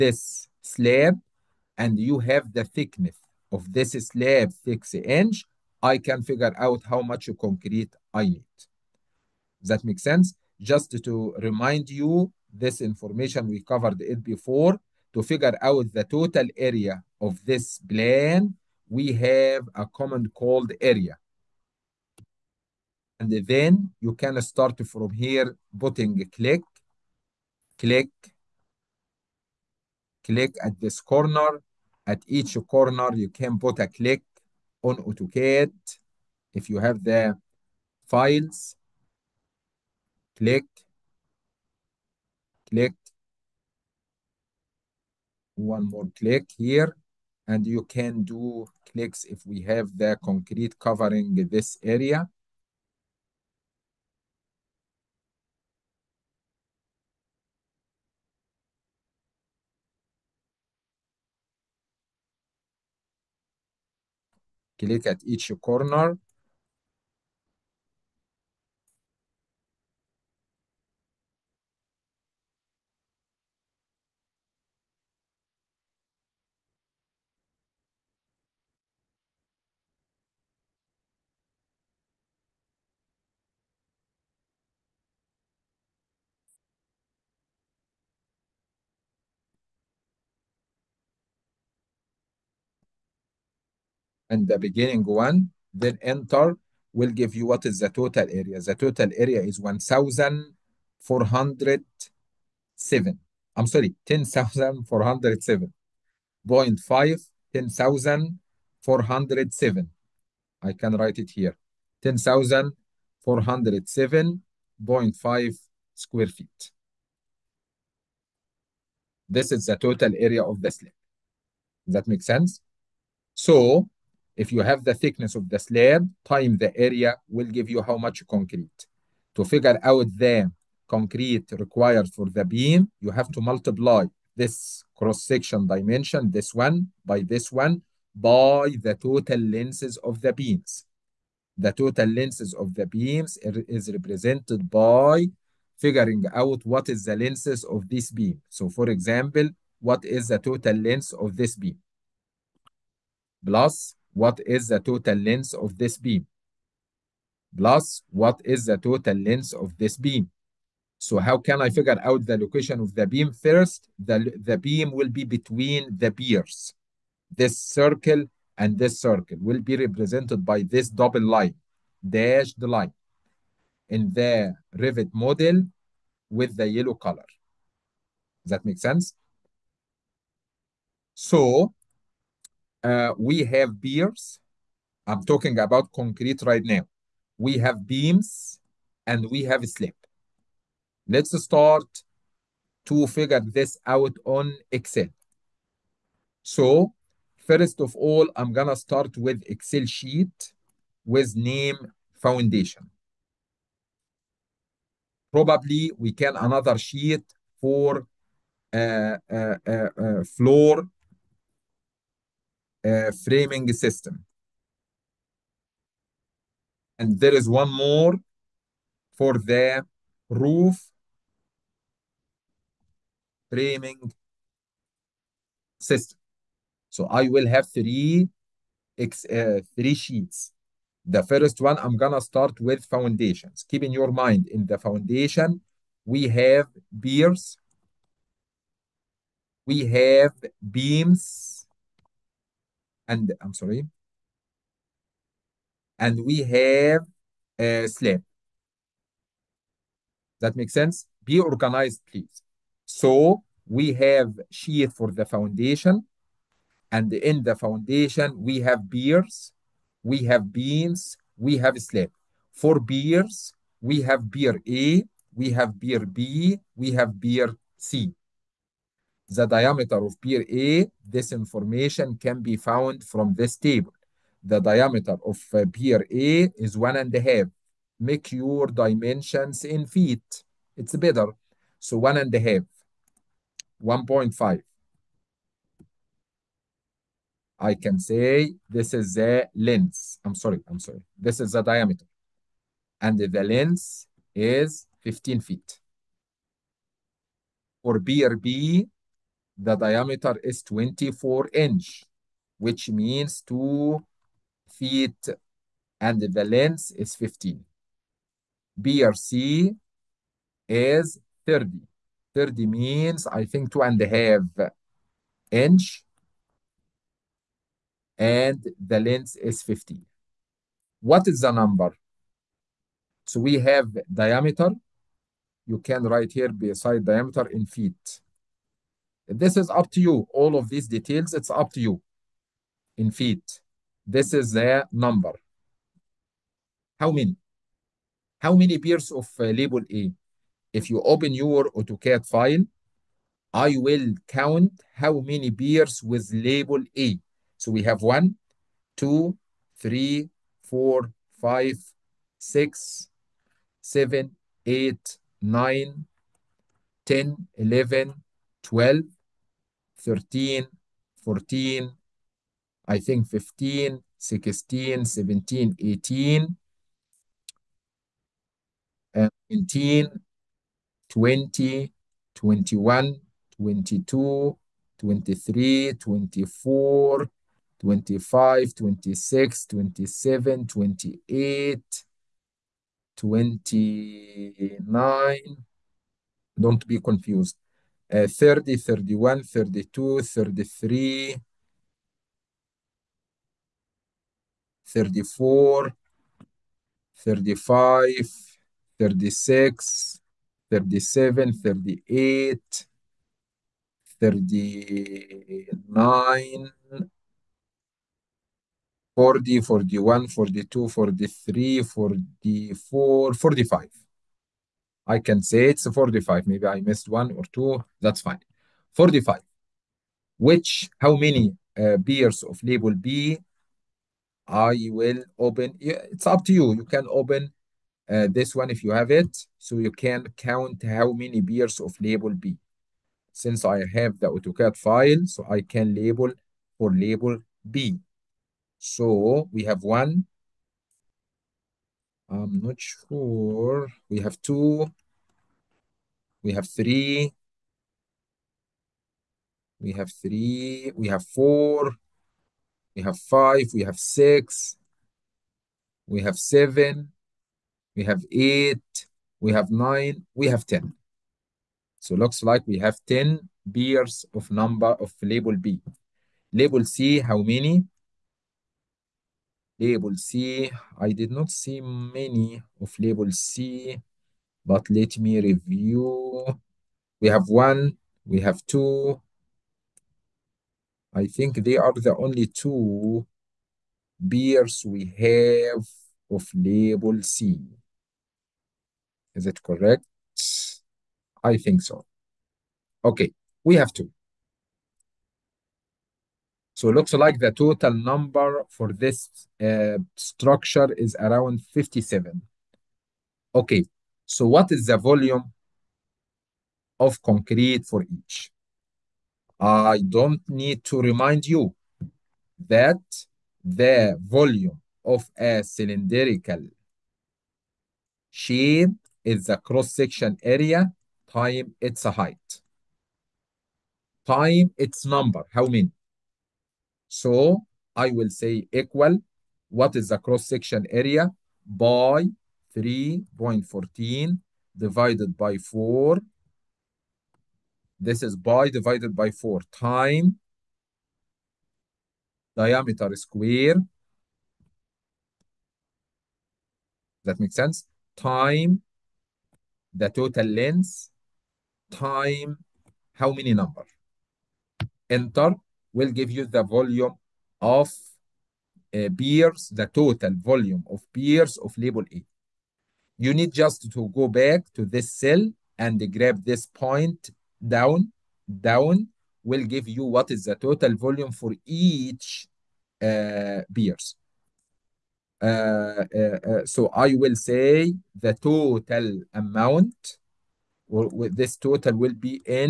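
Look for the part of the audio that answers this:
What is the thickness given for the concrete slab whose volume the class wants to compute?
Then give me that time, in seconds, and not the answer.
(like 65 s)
4 s.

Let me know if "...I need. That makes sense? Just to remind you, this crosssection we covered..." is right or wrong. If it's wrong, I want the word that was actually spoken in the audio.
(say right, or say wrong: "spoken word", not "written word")
wrong: "information", not "crosssection".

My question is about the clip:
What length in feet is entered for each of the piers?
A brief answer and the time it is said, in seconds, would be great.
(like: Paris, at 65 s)
15 feet, at 294 s.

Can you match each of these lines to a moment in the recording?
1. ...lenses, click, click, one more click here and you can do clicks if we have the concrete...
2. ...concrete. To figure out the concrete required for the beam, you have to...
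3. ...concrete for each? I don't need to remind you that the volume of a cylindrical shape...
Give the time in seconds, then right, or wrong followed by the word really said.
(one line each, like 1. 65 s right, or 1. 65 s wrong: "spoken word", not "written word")
1. 38 s wrong: "files", not "lenses"
2. 128 s right
3. 507 s right.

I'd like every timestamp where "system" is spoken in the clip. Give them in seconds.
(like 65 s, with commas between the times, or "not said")
213 s, 225 s.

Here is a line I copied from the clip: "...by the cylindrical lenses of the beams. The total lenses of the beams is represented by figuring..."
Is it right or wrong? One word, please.
wrong.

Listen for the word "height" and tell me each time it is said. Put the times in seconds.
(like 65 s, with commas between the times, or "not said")
522 s.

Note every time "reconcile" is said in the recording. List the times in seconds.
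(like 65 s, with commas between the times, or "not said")
not said.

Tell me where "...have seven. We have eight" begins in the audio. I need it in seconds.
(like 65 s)
456 s.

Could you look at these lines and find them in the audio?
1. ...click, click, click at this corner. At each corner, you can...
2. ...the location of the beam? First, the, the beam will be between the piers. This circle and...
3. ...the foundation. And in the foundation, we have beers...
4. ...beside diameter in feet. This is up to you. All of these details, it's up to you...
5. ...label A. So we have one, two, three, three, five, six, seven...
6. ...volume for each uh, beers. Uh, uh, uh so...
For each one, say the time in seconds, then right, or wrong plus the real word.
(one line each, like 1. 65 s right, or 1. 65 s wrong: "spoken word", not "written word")
1. 26 s right
2. 162 s right
3. 255 s right
4. 326 s right
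5. 346 s wrong: "four", not "three"
6. 570 s right.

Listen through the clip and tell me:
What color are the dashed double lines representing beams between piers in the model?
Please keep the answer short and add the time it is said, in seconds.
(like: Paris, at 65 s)
yellow, at 176 s.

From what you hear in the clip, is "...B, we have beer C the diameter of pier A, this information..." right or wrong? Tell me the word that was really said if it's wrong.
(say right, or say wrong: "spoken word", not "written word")
right.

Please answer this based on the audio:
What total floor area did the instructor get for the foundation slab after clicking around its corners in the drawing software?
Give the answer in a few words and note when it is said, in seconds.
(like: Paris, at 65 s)
10407.5 square feet, at 112 s.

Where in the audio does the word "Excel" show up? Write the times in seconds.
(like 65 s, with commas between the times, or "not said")
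194 s, 199 s.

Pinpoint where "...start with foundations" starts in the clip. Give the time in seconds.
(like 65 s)
232 s.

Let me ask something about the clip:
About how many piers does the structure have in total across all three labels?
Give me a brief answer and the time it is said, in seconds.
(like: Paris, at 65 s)
57, at 501 s.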